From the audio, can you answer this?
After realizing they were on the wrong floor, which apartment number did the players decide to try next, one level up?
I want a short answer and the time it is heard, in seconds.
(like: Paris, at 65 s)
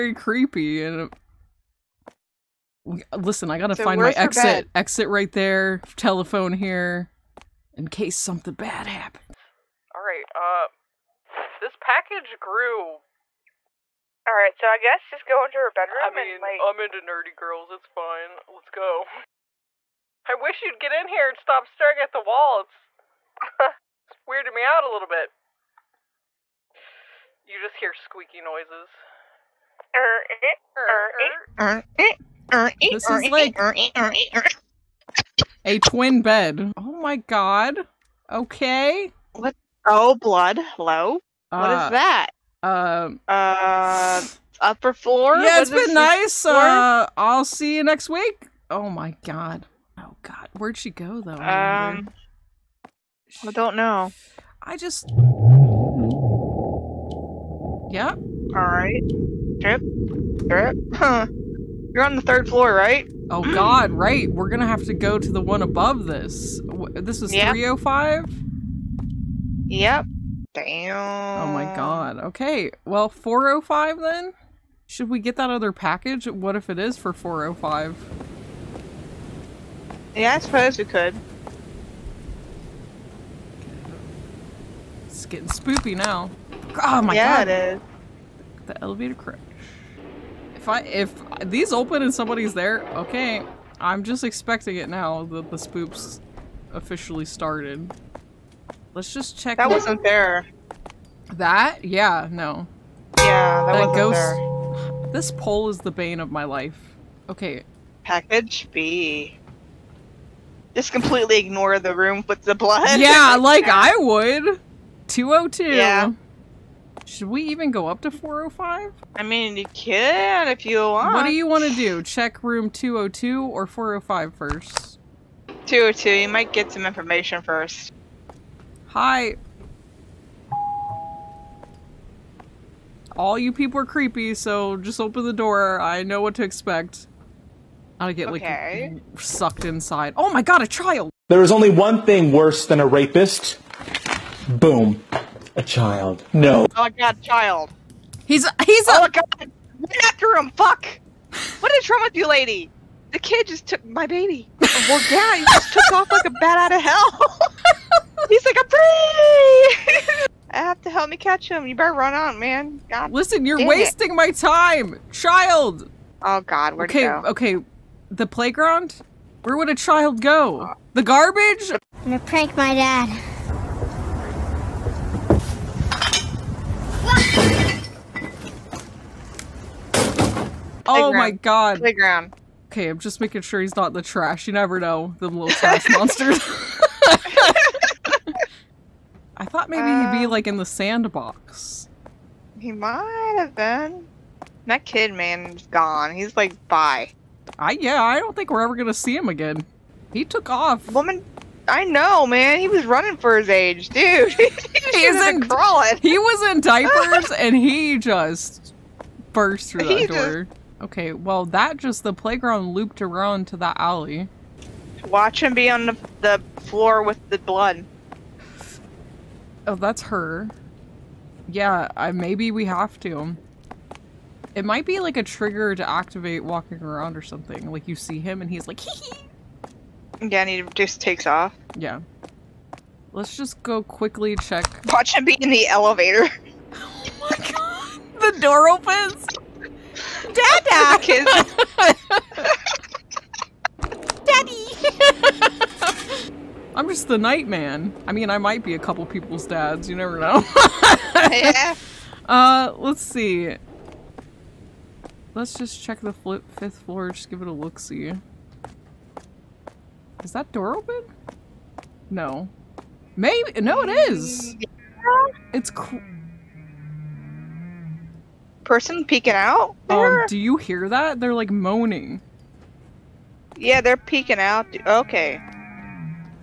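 405, at 73 s.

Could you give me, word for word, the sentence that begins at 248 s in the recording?
I mean, I might be a couple people's dads.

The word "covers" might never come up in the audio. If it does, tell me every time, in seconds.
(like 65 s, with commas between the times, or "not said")
not said.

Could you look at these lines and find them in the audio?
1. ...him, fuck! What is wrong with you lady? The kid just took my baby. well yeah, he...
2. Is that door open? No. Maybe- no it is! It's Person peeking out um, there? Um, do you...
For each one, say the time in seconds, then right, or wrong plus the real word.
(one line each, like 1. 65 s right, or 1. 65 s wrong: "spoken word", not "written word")
1. 150 s right
2. 260 s right.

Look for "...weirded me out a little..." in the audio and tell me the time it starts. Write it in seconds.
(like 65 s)
24 s.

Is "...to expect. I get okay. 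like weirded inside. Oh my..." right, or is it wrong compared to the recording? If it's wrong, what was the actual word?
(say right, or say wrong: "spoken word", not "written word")
wrong: "sucked", not "weirded".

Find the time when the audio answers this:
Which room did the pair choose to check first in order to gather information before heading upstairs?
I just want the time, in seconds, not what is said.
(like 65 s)
125 s.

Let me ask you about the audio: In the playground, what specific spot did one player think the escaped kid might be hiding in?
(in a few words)
The sandbox.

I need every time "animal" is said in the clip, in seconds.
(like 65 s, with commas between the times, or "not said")
not said.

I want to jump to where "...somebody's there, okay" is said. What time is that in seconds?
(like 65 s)
92 s.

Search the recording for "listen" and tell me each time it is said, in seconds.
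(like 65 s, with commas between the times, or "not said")
3 s, 163 s.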